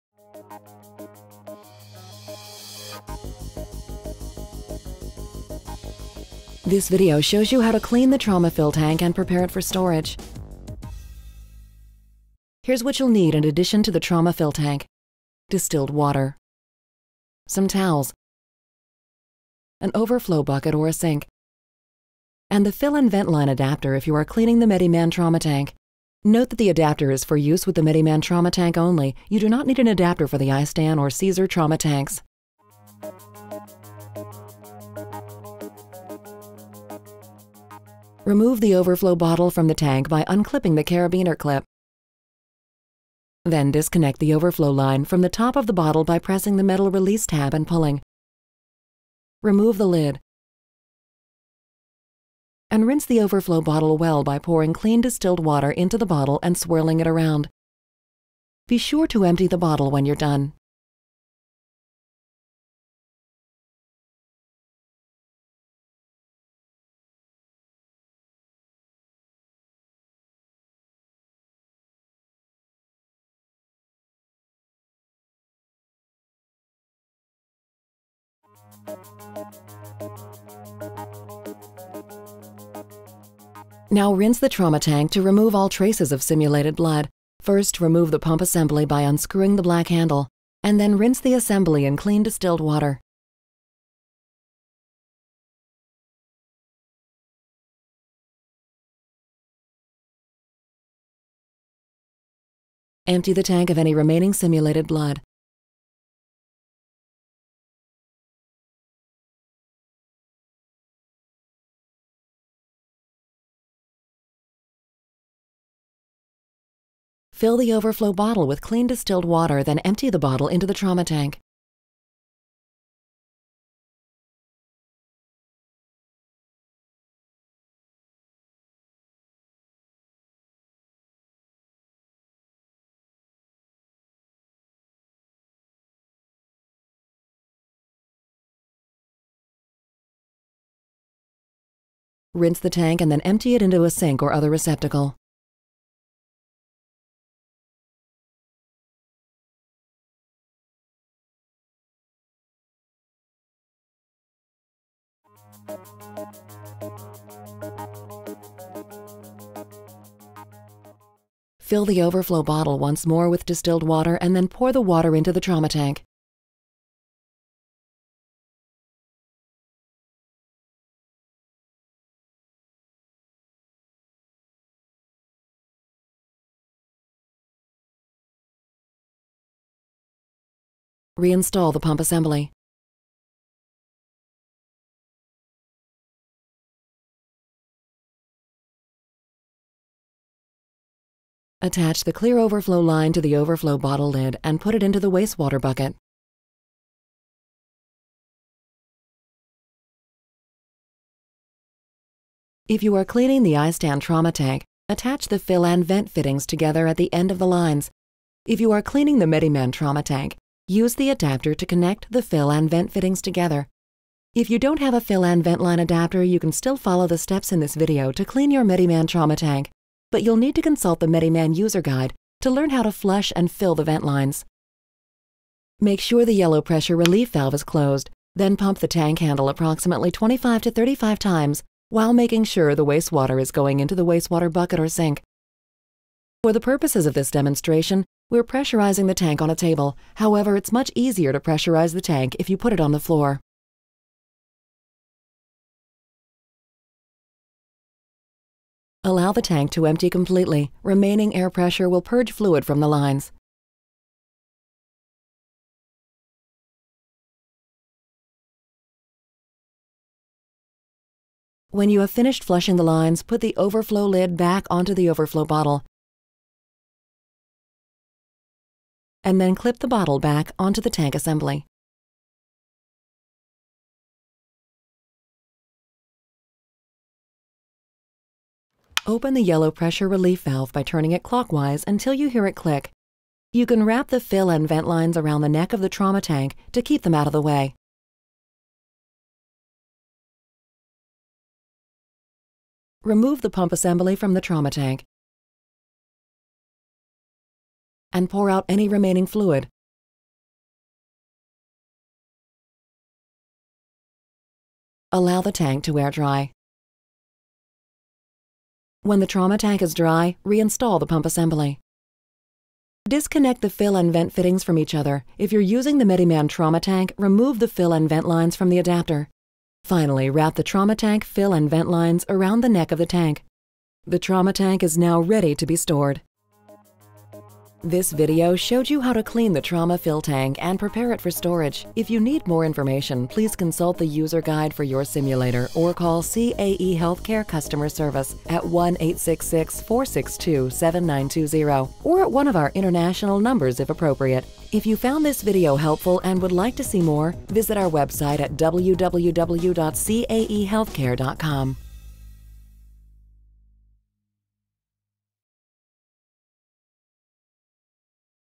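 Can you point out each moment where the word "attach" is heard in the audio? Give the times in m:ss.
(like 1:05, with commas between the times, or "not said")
3:11, 3:24.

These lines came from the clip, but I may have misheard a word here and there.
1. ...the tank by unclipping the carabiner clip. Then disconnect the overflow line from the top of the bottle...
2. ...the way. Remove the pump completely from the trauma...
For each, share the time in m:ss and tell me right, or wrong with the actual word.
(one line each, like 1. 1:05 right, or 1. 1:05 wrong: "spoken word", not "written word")
1. 0:39 right
2. 4:47 wrong: "assembly", not "completely".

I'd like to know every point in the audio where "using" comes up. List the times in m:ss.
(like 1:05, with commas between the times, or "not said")
5:15.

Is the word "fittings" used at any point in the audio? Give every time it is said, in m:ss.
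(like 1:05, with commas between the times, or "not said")
3:26, 3:32, 5:14.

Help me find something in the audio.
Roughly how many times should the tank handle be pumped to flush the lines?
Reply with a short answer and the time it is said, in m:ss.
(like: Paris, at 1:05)
25 to 35, at 3:50.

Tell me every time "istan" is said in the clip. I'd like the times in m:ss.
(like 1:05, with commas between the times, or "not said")
0:30, 3:23.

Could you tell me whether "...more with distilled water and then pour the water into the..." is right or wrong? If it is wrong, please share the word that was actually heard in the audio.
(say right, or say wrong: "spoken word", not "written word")
right.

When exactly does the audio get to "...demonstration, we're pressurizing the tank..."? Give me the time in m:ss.
3:57.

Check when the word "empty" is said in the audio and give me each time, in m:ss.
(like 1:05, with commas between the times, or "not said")
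0:59, 1:43, 1:59, 2:23, 4:09.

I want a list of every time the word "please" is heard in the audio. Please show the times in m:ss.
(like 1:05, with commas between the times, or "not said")
5:33.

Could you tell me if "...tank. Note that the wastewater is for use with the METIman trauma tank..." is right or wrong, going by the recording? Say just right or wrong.
wrong.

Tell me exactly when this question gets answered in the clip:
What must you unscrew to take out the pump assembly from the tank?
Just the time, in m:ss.
1:29.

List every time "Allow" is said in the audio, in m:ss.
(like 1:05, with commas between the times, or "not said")
4:09, 5:05.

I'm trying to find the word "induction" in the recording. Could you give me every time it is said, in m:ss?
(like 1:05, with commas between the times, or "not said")
not said.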